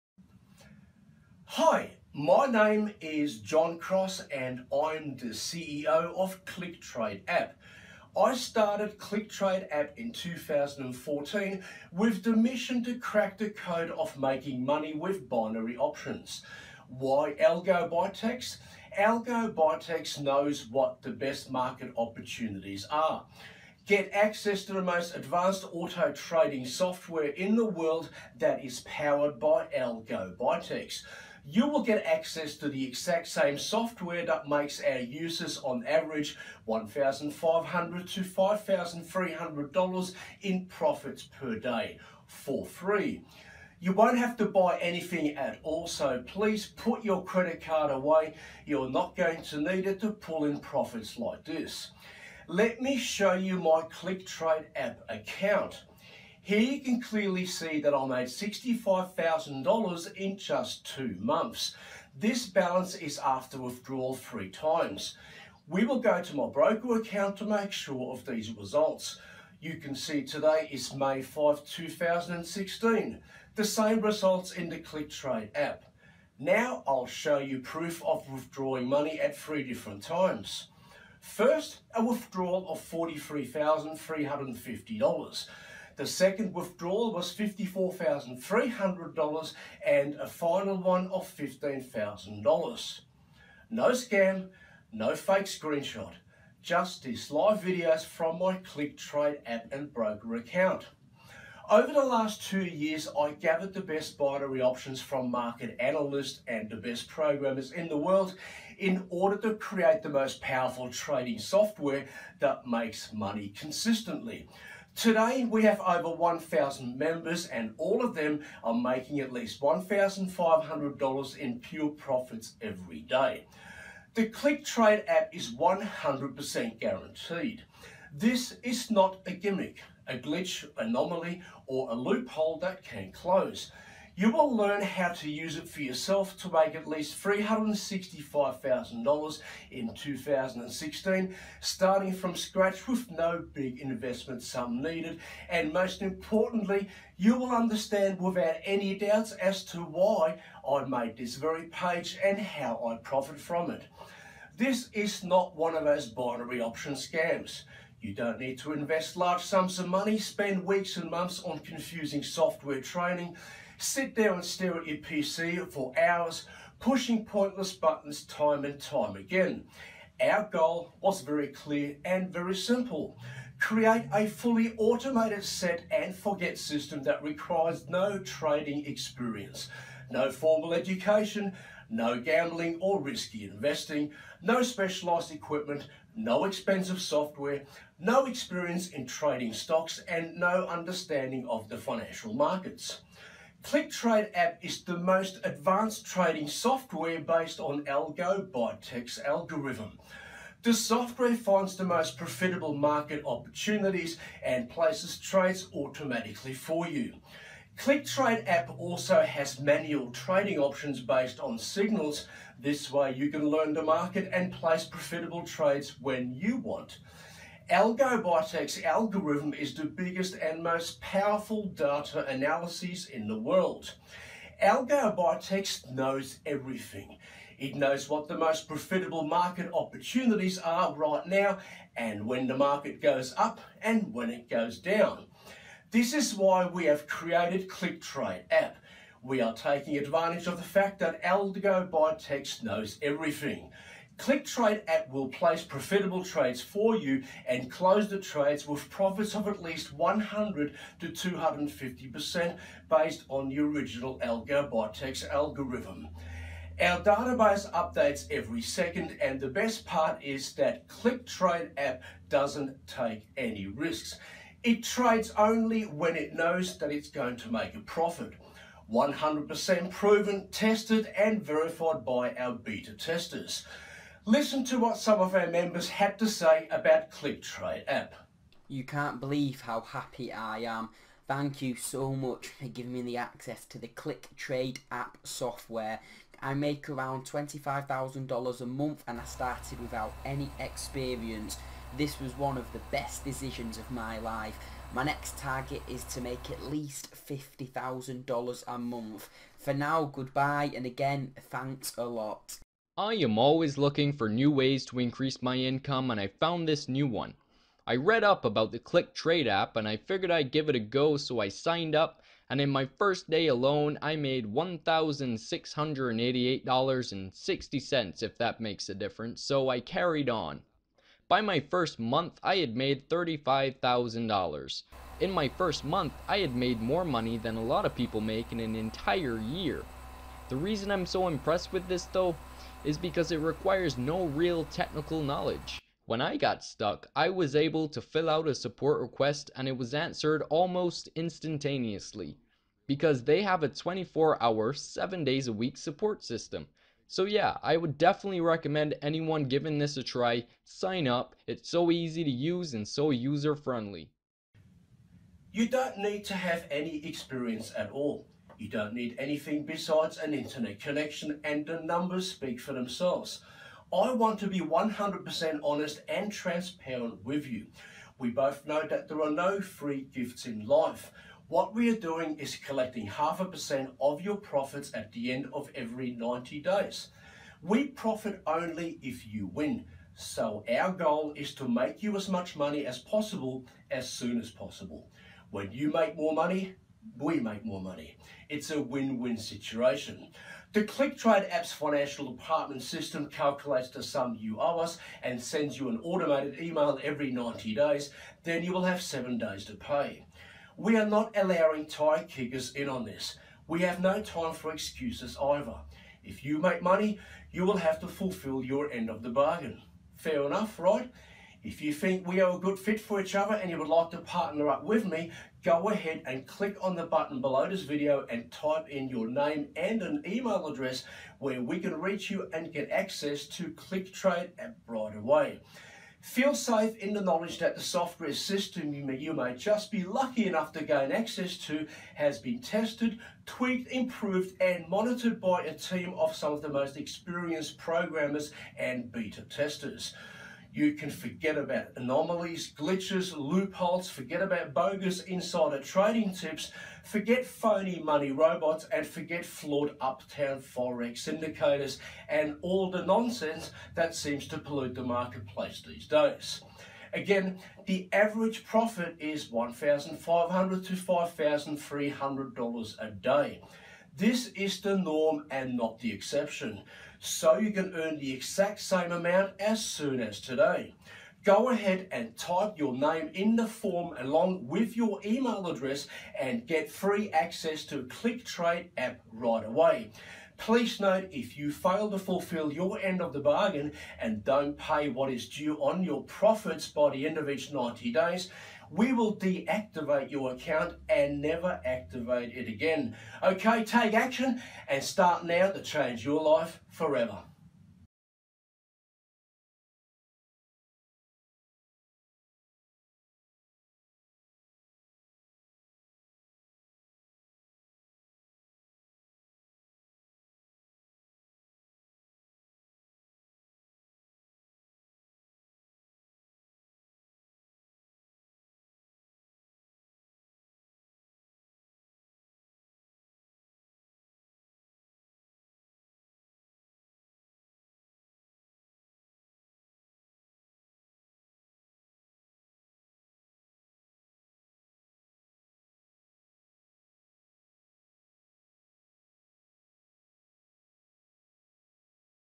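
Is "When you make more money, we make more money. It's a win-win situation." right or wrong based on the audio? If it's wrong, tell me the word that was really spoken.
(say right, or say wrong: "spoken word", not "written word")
right.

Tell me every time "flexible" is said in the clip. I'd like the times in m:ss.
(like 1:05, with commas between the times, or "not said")
not said.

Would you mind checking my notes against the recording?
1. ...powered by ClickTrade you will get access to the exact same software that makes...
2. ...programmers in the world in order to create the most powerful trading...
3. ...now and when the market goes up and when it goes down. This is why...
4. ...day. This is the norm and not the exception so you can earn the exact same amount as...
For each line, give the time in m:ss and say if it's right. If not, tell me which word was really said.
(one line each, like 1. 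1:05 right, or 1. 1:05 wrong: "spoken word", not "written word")
1. 0:28 wrong: "Algo", not "ClickTrade"
2. 1:47 right
3. 3:51 right
4. 7:43 right.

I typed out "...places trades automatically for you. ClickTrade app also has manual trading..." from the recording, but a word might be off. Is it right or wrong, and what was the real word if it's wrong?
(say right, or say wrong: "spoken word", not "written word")
right.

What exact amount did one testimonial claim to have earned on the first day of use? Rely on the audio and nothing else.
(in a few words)
$1,688.60.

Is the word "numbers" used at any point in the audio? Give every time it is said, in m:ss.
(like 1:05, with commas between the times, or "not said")
6:01.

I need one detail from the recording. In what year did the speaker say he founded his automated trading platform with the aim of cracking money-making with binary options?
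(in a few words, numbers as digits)
2014.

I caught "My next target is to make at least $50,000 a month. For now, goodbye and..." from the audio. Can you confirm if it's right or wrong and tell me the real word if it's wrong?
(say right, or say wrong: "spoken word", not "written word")
right.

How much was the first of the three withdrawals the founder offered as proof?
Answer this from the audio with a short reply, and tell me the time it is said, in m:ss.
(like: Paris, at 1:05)
$43,350, at 1:22.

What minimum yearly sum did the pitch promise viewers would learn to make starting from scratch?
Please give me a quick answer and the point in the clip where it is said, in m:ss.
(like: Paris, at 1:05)
$365,000, at 2:17.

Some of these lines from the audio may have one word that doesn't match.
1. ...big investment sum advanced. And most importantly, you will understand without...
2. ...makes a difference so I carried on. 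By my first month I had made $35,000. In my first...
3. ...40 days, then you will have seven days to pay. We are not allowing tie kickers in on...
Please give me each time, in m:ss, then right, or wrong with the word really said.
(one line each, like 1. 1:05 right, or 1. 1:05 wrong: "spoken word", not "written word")
1. 2:23 wrong: "needed", not "advanced"
2. 5:18 right
3. 6:37 wrong: "90", not "40".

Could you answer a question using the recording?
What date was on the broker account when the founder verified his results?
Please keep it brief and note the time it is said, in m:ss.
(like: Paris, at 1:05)
May 5, 2016, at 1:10.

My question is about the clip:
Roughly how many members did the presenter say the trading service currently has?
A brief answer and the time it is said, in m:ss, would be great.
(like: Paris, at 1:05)
over 1,000, at 1:55.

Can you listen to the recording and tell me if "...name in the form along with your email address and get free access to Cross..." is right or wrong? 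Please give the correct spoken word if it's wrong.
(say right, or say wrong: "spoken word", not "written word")
wrong: "ClickTrade", not "Cross".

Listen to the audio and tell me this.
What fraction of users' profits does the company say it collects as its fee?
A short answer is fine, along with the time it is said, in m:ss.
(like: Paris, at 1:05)
half a percent, at 6:13.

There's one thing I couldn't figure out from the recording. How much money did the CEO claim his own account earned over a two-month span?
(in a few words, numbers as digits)
$65,000.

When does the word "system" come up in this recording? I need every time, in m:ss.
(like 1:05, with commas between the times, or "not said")
2:56, 5:46, 6:32, 7:08.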